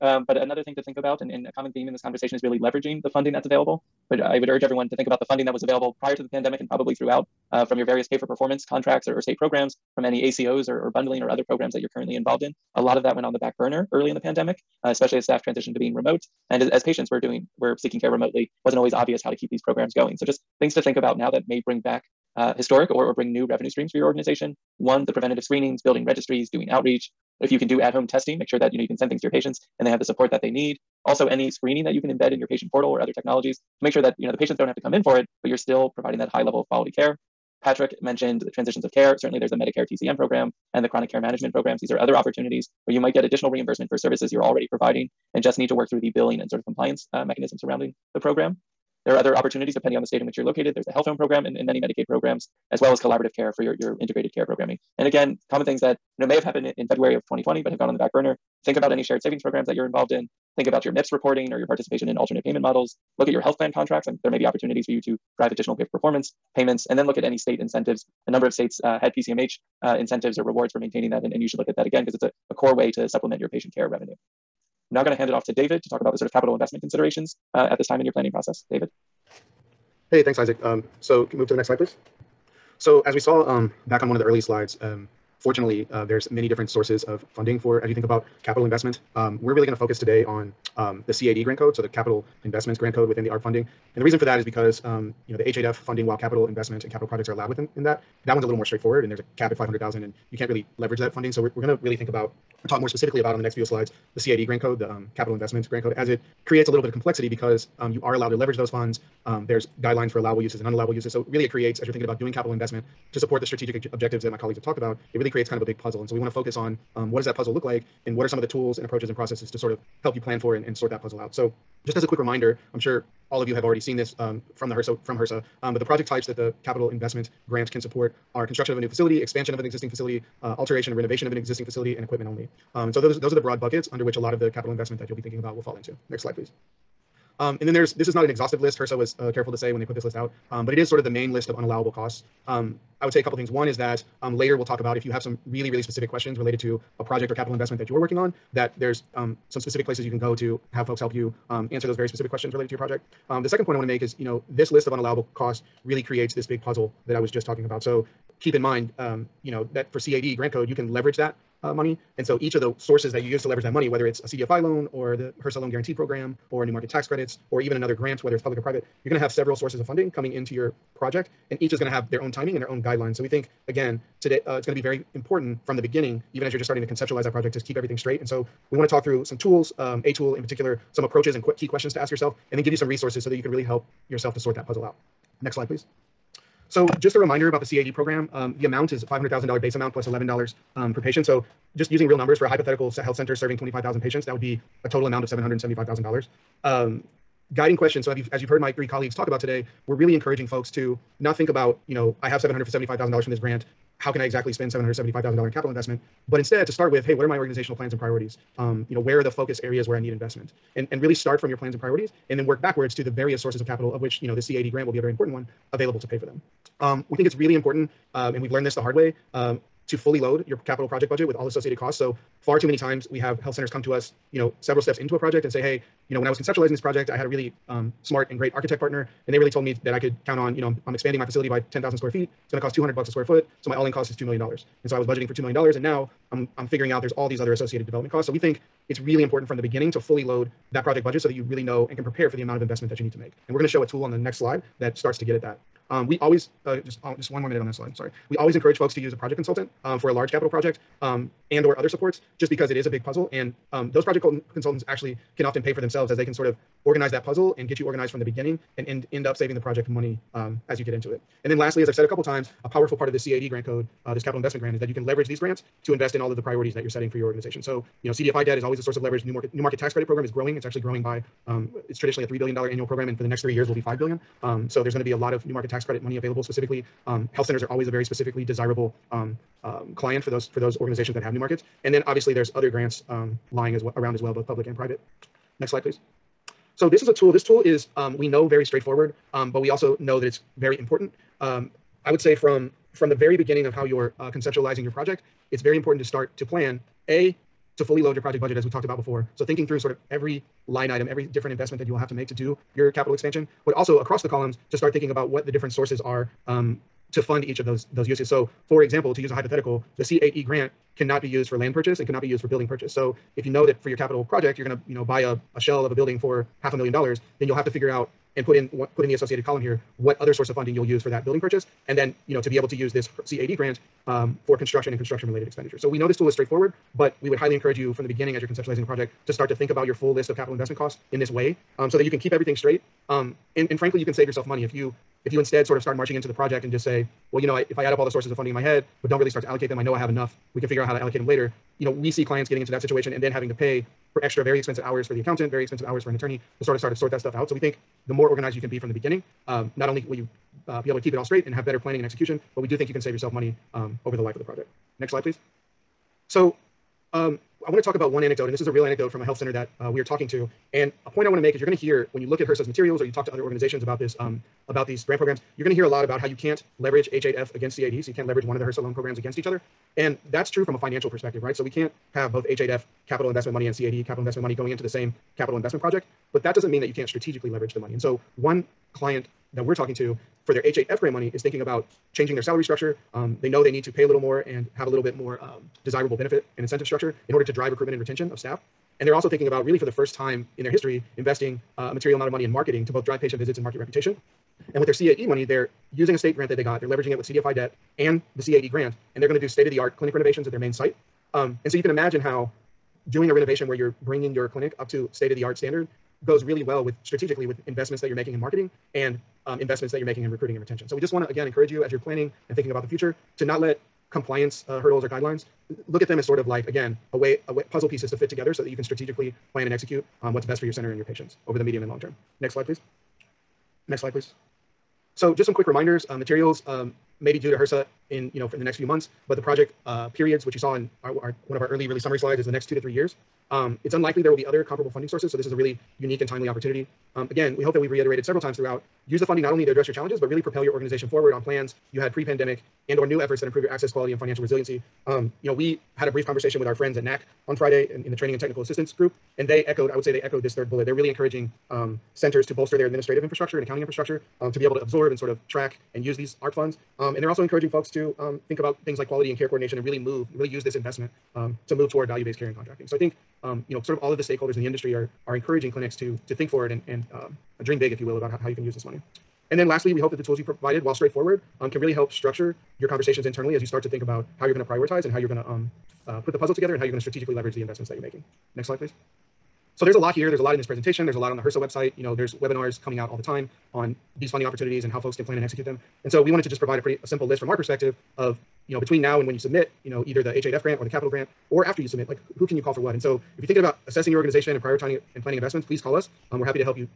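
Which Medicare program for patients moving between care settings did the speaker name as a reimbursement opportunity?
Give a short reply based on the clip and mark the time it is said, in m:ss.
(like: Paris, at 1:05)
TCM, at 0:39.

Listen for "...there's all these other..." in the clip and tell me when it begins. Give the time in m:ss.
3:57.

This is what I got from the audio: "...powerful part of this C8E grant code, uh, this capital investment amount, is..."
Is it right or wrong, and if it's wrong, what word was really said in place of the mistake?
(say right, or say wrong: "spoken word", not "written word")
wrong: "grant", not "amount".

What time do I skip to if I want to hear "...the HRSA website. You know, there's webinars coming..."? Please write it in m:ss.
8:01.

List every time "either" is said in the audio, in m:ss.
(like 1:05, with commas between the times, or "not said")
8:10.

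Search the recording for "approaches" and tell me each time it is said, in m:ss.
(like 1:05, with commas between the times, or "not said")
1:58, 3:01.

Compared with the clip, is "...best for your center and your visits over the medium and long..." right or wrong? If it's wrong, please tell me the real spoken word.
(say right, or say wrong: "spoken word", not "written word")
wrong: "patients", not "visits".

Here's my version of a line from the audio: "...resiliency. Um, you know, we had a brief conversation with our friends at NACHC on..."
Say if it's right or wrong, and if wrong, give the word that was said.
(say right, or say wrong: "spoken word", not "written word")
right.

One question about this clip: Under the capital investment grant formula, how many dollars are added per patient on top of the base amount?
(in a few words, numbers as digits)
$11.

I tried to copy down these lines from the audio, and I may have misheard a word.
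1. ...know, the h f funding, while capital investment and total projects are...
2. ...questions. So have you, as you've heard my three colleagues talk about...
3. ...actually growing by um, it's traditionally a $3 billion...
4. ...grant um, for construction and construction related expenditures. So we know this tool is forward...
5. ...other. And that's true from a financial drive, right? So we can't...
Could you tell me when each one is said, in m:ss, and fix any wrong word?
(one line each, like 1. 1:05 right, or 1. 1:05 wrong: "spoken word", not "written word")
1. 1:35 wrong: "capital", not "total"
2. 3:17 right
3. 4:30 right
4. 5:23 wrong: "straightforward", not "forward"
5. 6:09 wrong: "perspective", not "drive".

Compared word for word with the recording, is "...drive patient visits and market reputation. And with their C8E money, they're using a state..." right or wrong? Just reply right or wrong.
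right.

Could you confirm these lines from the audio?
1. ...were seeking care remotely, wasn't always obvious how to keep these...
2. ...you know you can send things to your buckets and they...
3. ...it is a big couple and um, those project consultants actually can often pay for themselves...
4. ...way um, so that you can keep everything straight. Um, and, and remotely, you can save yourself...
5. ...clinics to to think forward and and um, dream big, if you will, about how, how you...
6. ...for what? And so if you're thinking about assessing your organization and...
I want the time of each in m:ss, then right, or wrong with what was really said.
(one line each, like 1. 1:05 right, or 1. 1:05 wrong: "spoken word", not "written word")
1. 0:17 right
2. 0:28 wrong: "patients", not "buckets"
3. 4:12 wrong: "puzzle", not "couple"
4. 5:31 wrong: "frankly", not "remotely"
5. 7:45 right
6. 8:12 right.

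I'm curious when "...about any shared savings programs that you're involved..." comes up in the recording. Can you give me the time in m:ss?
0:58.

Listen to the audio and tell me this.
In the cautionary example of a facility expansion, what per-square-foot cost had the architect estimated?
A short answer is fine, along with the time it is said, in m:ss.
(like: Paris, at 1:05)
200 bucks, at 3:52.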